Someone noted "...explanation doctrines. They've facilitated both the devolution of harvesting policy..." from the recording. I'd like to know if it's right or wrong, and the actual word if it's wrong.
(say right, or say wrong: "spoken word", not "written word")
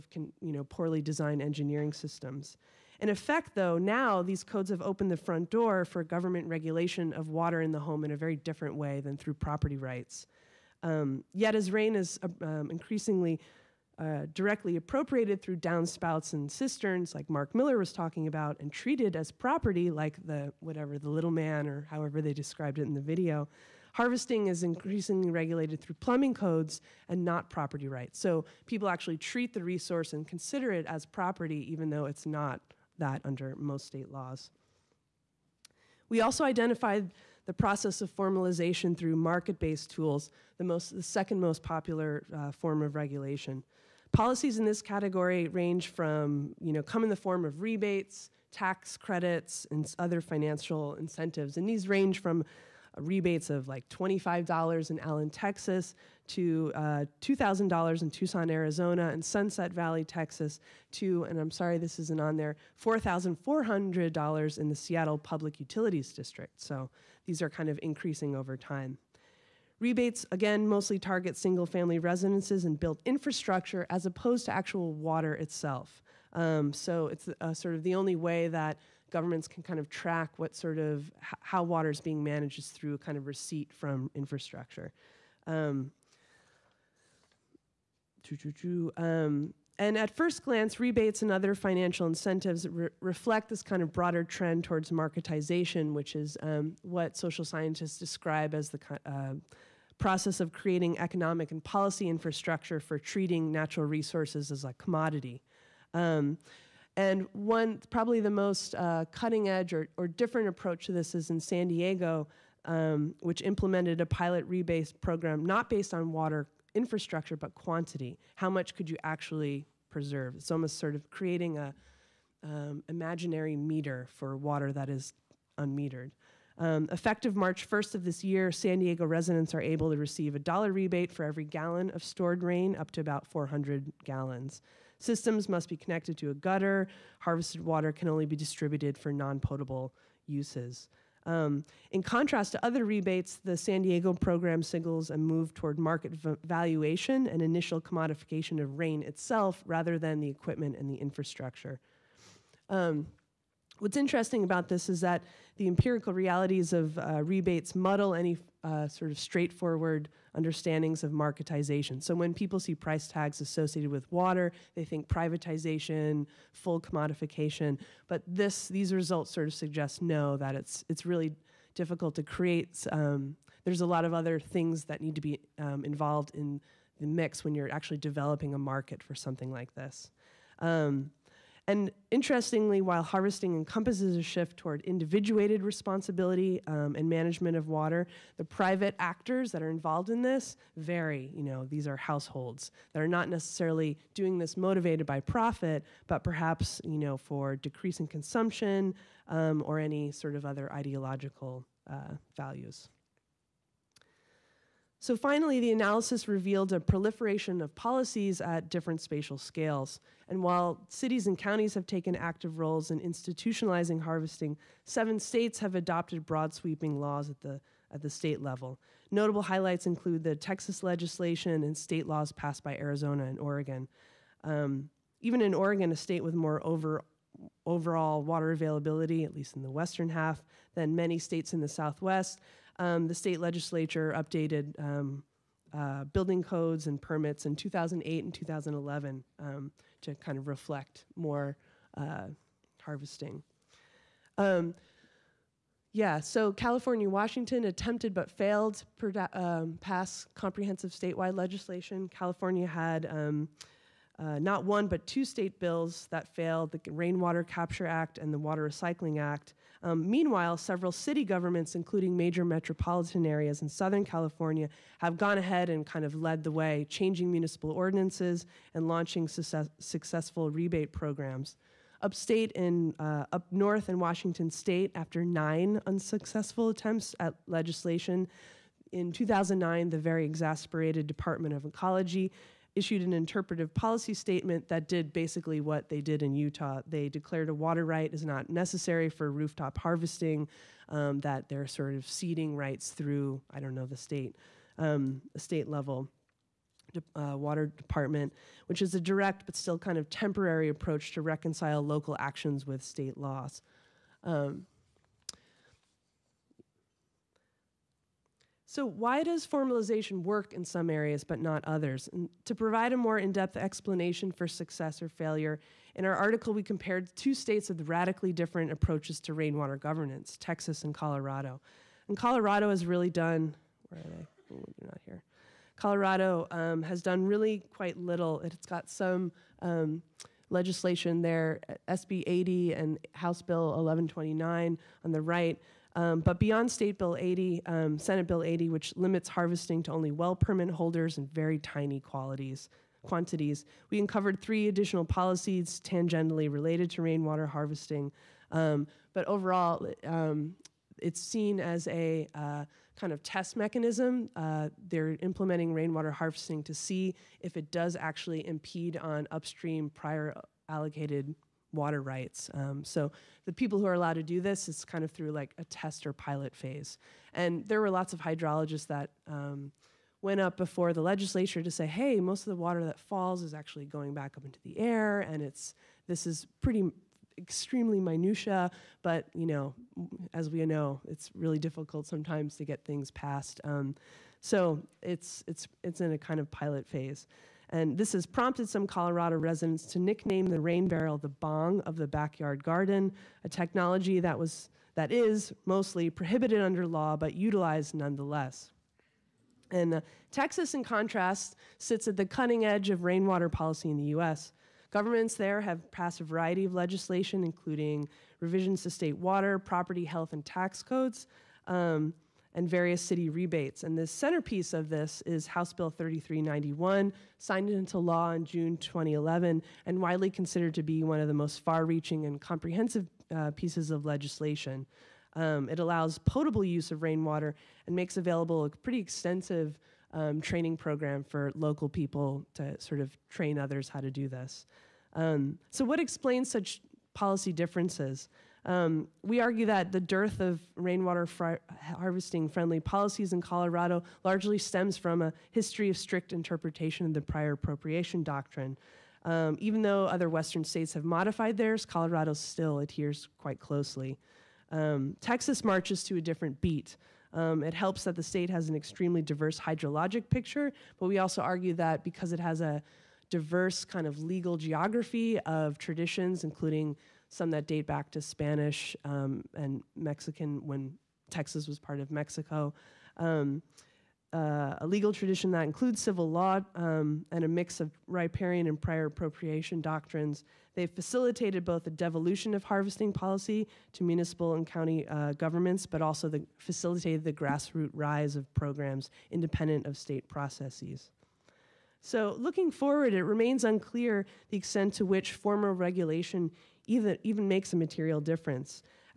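wrong: "appropriation", not "explanation".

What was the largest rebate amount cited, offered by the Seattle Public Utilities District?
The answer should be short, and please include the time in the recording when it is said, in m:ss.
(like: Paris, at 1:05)
$4,400, at 1:02.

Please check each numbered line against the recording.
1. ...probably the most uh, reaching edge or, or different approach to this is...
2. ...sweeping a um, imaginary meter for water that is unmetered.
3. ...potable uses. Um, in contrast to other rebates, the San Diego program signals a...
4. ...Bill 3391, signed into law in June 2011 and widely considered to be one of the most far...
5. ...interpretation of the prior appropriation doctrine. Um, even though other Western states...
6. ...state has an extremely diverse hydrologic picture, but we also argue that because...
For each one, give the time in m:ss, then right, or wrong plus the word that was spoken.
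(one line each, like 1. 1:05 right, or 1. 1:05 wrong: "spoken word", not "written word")
1. 1:47 wrong: "cutting", not "reaching"
2. 2:01 wrong: "creating", not "sweeping"
3. 2:19 right
4. 6:55 right
5. 7:26 right
6. 7:38 right.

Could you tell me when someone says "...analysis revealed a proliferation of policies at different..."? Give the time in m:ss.
3:25.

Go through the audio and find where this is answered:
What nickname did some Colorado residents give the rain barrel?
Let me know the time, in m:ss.
6:31.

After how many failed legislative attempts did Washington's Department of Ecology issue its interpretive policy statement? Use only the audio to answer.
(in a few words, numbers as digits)
9.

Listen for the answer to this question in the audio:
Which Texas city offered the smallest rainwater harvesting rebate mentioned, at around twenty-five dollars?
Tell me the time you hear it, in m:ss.
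0:54.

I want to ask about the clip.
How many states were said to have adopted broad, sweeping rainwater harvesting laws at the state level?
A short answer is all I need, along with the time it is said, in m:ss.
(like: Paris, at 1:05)
7, at 3:34.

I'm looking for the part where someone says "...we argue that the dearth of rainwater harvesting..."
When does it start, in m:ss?
7:19.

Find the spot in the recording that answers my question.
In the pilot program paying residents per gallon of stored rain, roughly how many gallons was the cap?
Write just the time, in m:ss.
2:13.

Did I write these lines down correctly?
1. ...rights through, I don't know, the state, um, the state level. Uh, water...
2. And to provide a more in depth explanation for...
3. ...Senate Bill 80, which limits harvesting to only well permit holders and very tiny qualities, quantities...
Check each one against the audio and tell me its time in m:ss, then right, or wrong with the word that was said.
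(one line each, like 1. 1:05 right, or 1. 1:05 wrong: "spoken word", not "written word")
1. 4:52 right
2. 5:12 right
3. 5:37 right.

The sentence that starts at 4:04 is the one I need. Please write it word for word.
Um, yeah, so California, Washington attempted but failed to um, pass comprehensive statewide legislation.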